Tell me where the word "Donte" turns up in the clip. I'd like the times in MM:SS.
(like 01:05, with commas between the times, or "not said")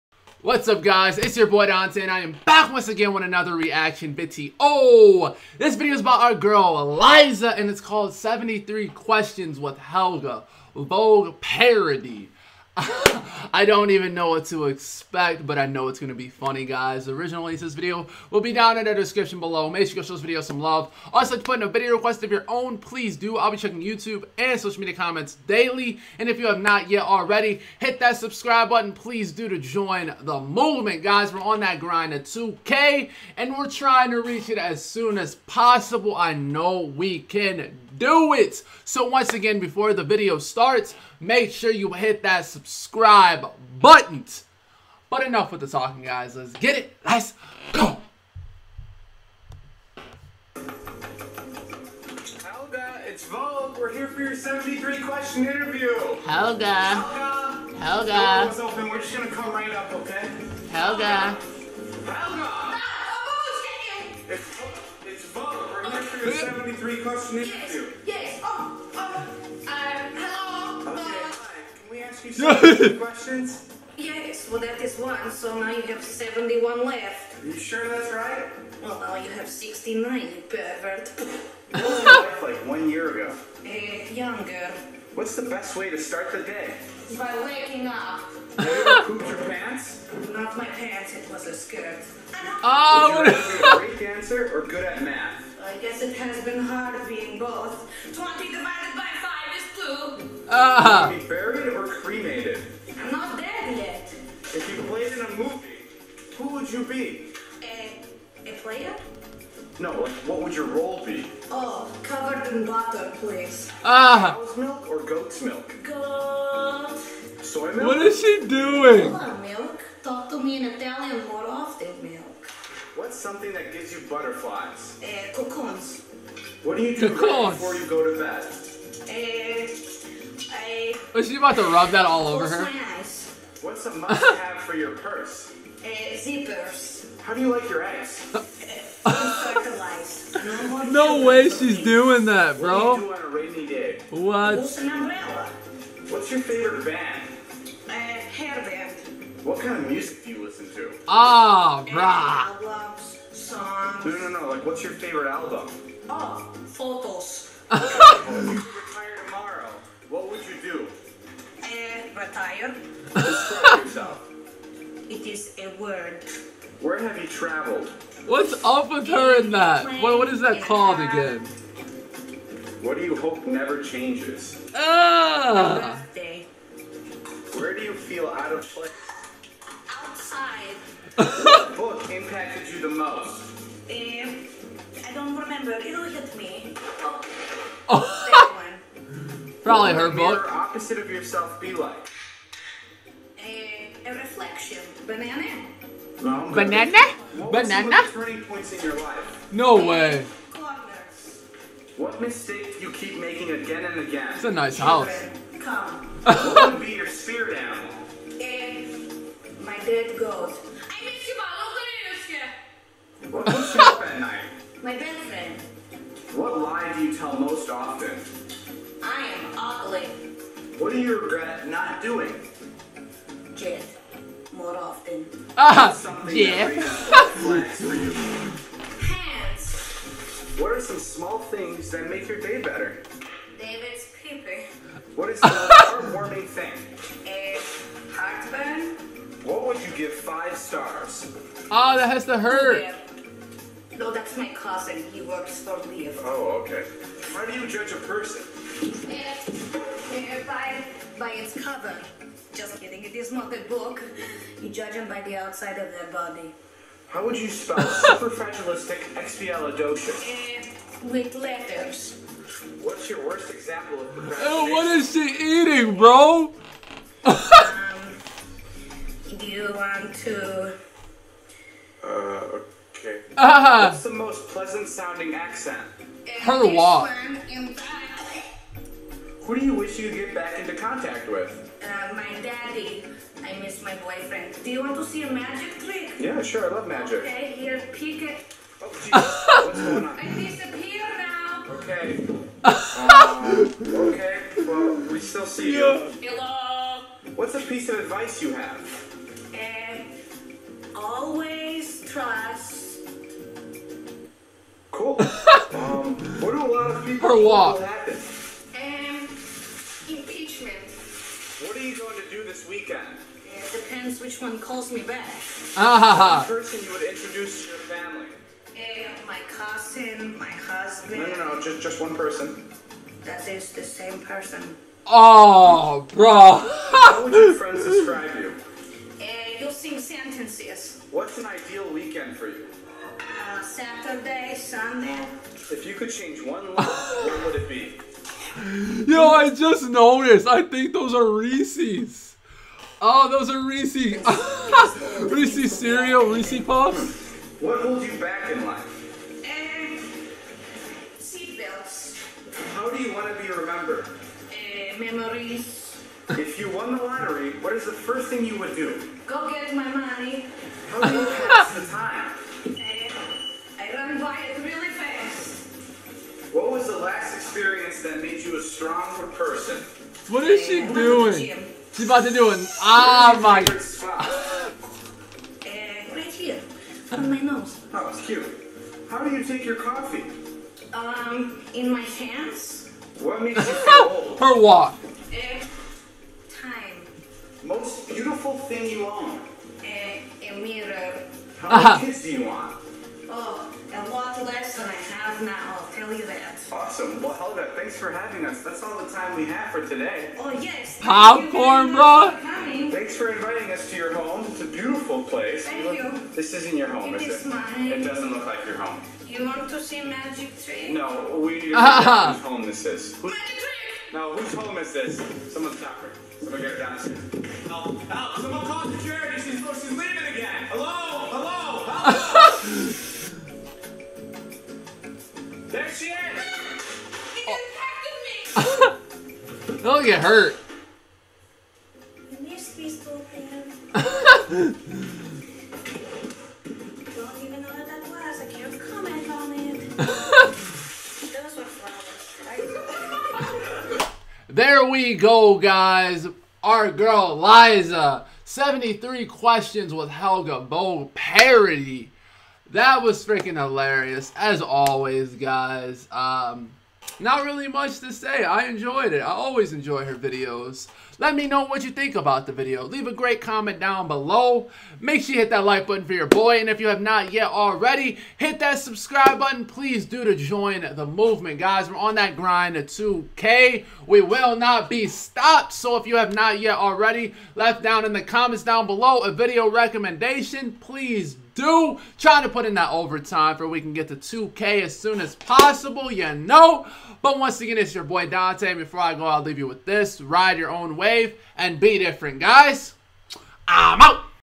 00:01, 08:08.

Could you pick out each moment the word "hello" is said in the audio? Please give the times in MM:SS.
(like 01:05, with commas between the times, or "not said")
01:10, 04:56.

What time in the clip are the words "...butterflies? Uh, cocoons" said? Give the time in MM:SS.
02:04.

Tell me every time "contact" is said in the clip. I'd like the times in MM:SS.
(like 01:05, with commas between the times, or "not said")
04:40.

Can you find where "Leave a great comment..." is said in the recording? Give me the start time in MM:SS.
07:42.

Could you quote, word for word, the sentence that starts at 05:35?
If you could change one look, what would it be?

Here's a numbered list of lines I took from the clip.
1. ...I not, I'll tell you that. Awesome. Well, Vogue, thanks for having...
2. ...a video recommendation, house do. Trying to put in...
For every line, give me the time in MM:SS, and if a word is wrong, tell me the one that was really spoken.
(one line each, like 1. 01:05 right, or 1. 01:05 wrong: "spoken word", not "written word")
1. 06:34 wrong: "Helga", not "Vogue"
2. 07:59 wrong: "please", not "house".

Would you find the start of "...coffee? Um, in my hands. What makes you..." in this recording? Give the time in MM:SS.
06:19.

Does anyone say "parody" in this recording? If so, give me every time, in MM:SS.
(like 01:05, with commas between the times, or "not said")
00:11, 07:31.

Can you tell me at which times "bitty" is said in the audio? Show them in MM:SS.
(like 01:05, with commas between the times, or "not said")
00:04.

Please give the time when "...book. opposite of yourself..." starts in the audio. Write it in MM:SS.
03:10.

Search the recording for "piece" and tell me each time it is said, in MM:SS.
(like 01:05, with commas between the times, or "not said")
04:57.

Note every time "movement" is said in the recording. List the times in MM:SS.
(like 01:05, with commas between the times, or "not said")
00:30, 07:51.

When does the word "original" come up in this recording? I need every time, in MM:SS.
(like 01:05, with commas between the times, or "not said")
00:17.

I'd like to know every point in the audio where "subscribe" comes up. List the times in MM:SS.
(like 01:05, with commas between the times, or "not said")
00:28, 00:42, 07:48.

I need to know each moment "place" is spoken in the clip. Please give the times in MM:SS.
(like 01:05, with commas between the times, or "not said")
02:58, 06:45.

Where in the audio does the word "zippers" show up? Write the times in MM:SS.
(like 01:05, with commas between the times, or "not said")
02:16.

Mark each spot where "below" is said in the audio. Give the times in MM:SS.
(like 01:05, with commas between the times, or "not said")
00:19, 07:44, 07:58.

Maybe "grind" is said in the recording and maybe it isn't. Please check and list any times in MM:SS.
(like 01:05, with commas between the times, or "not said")
00:31, 07:52.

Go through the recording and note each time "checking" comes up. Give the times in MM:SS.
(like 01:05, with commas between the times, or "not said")
00:23.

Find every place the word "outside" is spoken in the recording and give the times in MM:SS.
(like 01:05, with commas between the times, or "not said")
03:00, 04:15.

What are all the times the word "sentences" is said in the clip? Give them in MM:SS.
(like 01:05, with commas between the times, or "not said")
05:29.